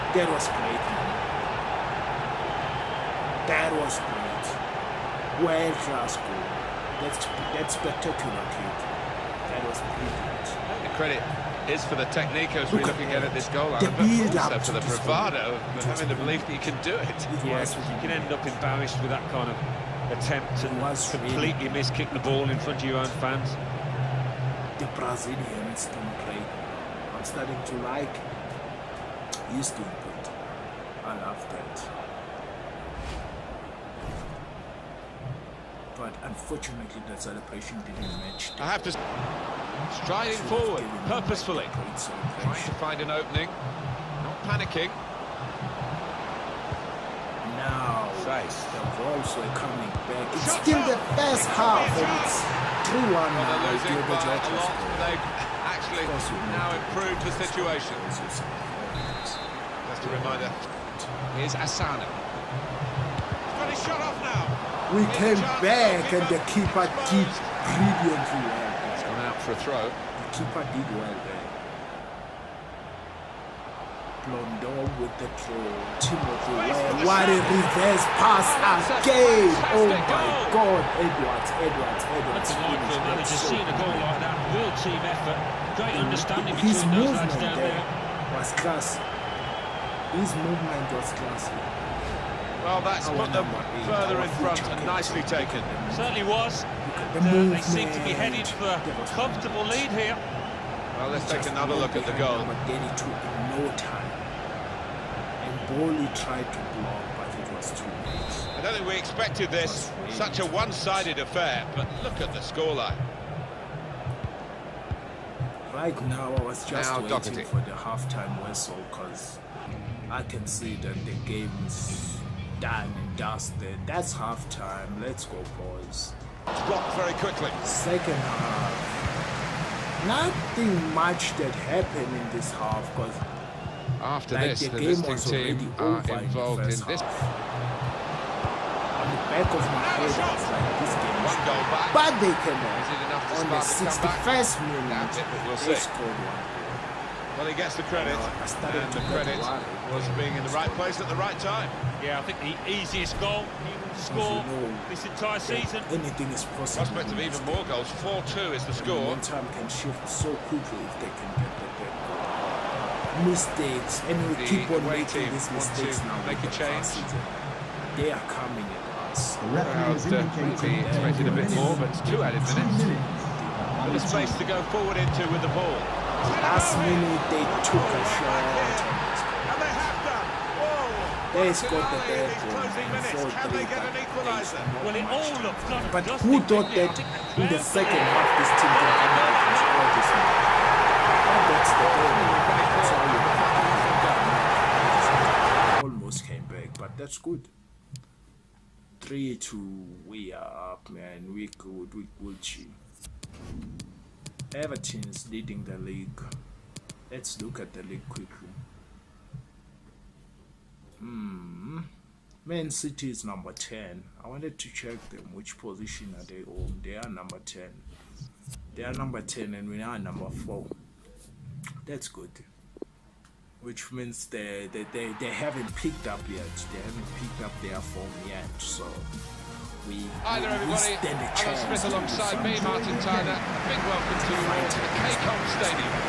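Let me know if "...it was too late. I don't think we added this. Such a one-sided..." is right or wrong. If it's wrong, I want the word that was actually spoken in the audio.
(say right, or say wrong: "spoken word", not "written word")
wrong: "expected", not "added".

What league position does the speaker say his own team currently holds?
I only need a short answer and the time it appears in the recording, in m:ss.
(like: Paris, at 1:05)
4, at 3:39.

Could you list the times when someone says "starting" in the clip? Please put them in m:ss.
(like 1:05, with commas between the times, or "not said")
0:27.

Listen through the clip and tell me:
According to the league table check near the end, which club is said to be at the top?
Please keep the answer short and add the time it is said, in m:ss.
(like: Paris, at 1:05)
Everton, at 3:24.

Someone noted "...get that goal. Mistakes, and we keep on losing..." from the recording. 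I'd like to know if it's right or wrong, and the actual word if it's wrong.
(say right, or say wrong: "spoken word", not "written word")
wrong: "making", not "losing".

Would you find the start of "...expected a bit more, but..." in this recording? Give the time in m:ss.
2:50.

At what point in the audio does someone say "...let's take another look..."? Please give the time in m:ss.
1:41.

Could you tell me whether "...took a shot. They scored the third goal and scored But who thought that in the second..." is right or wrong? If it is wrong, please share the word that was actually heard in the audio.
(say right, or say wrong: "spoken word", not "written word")
right.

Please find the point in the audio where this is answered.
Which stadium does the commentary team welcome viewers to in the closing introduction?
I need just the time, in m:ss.
3:55.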